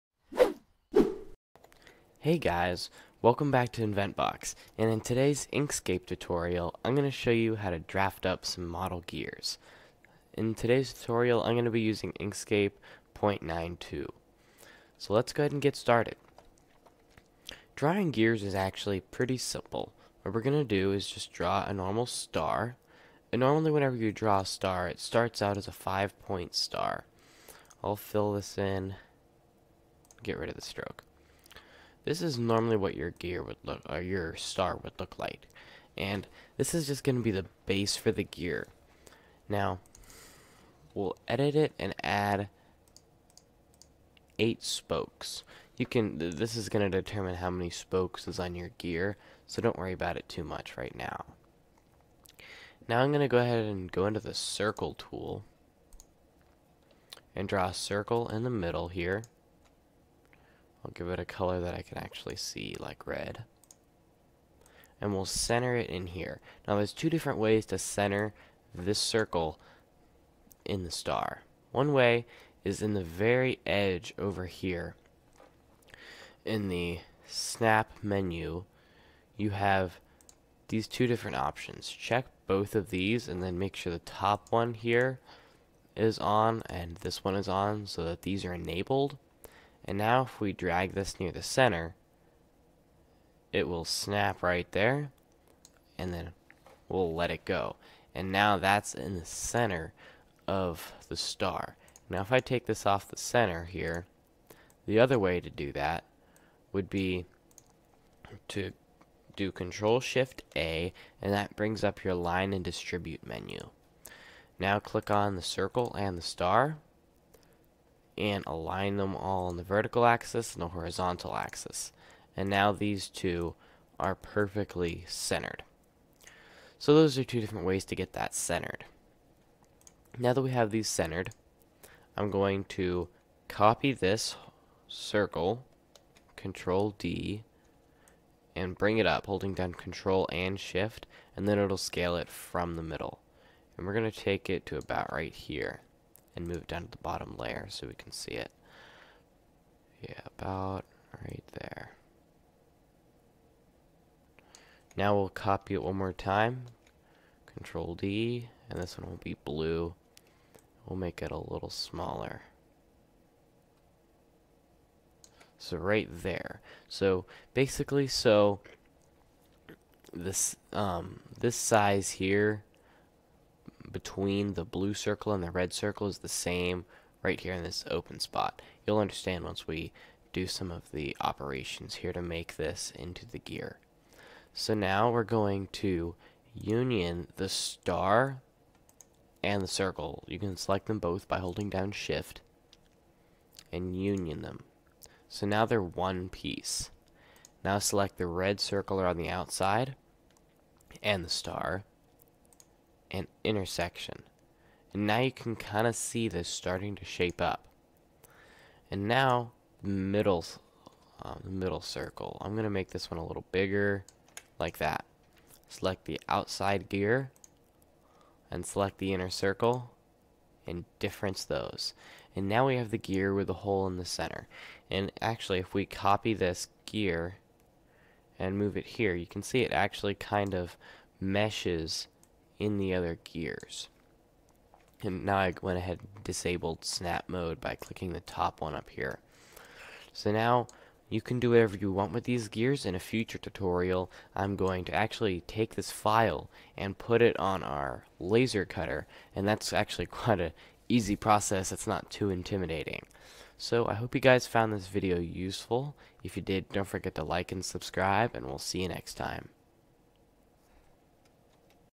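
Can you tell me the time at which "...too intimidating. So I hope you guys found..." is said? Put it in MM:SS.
04:12.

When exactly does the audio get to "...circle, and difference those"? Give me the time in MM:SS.
03:39.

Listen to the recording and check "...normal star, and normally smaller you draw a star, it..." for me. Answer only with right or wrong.
wrong.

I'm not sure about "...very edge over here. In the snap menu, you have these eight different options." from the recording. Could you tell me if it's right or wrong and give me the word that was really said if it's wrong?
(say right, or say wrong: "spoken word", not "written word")
wrong: "two", not "eight".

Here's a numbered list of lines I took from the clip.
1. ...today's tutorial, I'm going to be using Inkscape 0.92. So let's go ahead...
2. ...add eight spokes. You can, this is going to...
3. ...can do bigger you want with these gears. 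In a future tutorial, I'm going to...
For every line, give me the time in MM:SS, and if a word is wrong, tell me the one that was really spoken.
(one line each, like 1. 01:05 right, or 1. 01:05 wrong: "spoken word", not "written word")
1. 00:10 right
2. 00:42 right
3. 04:01 wrong: "whatever", not "bigger".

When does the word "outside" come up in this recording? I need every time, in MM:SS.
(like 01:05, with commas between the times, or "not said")
03:19, 03:36.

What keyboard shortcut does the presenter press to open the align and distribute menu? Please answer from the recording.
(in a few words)
Control Shift A.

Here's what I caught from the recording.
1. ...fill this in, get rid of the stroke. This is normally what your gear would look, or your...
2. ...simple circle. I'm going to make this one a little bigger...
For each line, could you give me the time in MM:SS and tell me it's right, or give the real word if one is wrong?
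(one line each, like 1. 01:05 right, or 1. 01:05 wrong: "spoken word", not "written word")
1. 00:27 right
2. 03:31 wrong: "middle", not "simple".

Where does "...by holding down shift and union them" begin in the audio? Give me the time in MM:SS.
03:11.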